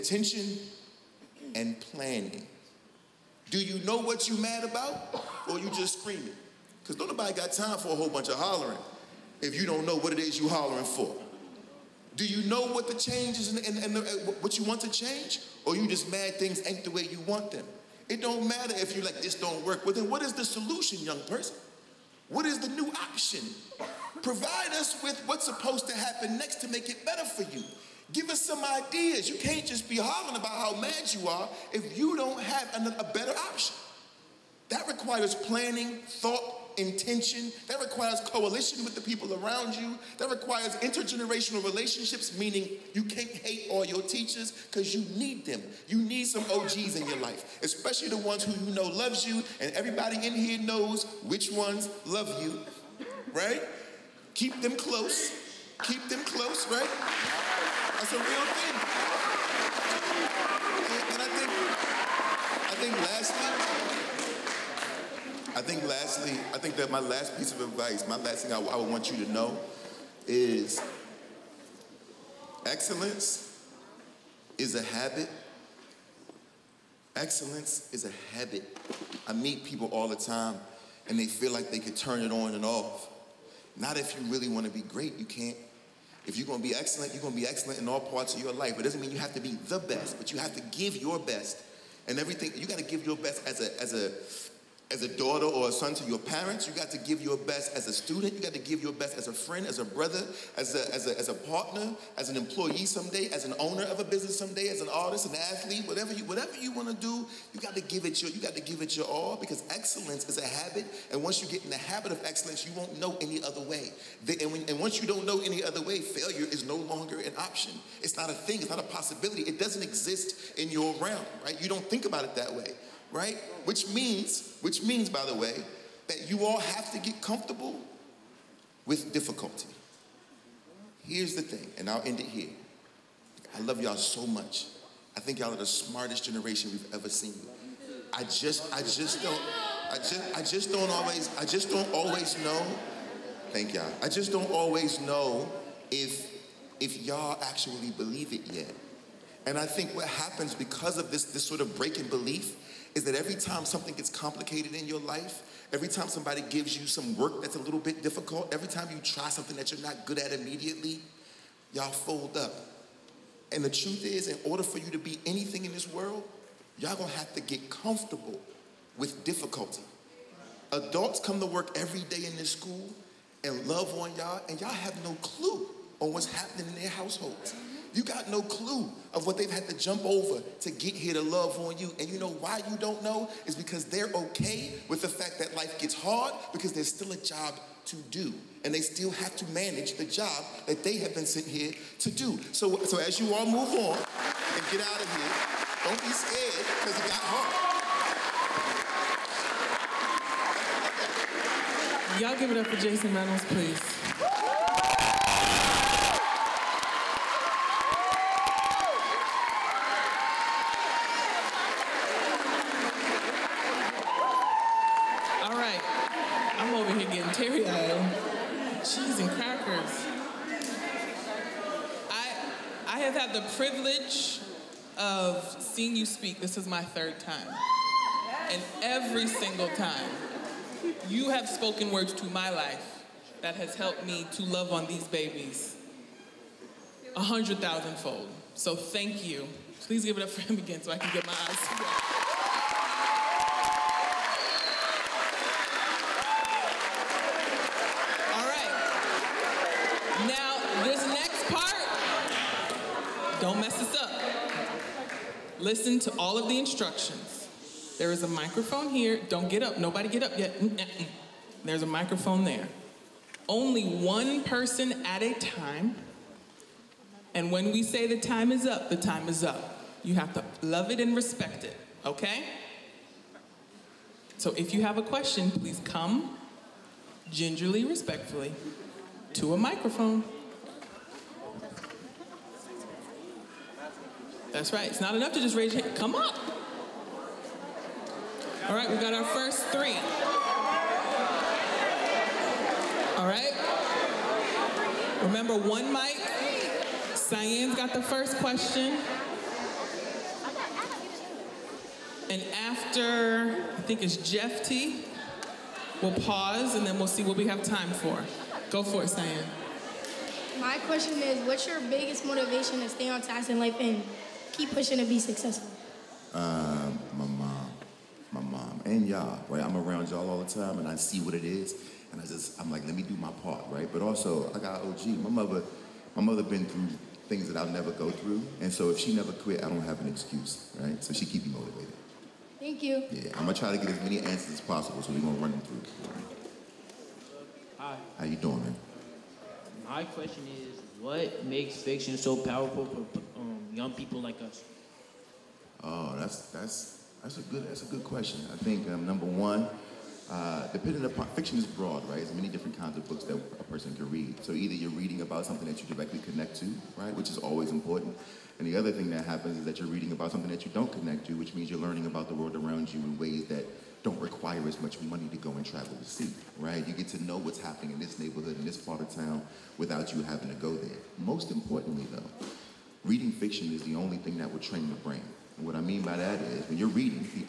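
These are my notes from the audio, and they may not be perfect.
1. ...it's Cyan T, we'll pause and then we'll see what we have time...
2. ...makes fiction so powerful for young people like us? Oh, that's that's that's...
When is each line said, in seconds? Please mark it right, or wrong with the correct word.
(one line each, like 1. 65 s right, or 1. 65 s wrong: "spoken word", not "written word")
1. 304 s wrong: "Jeff", not "Cyan"
2. 341 s right.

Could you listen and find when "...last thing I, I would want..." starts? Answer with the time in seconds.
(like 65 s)
68 s.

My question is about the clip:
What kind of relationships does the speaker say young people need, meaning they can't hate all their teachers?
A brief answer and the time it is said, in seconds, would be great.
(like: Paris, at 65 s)
intergenerational relationships, at 40 s.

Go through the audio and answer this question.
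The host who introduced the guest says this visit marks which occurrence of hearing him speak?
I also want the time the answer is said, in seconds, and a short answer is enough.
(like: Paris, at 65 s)
third time, at 226 s.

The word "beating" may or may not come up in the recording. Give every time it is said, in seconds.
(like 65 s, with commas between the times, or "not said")
not said.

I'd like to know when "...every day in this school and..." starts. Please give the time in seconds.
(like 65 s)
171 s.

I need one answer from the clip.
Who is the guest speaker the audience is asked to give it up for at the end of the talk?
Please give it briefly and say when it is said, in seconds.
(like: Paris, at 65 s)
Jason Reynolds, at 202 s.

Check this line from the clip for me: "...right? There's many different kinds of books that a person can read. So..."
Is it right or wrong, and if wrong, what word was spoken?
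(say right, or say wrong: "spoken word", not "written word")
right.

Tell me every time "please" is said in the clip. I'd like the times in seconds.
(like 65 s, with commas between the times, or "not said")
203 s, 239 s, 275 s.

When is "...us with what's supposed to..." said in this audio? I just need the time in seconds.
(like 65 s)
24 s.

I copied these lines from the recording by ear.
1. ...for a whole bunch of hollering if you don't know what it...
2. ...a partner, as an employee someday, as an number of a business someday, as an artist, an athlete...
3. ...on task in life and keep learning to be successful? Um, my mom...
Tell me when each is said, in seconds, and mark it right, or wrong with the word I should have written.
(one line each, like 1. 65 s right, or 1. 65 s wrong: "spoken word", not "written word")
1. 7 s right
2. 101 s wrong: "owner", not "number"
3. 313 s wrong: "pushing", not "learning".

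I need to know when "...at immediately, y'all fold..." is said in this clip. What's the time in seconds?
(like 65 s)
160 s.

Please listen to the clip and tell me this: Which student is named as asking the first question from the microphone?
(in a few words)
Cyane.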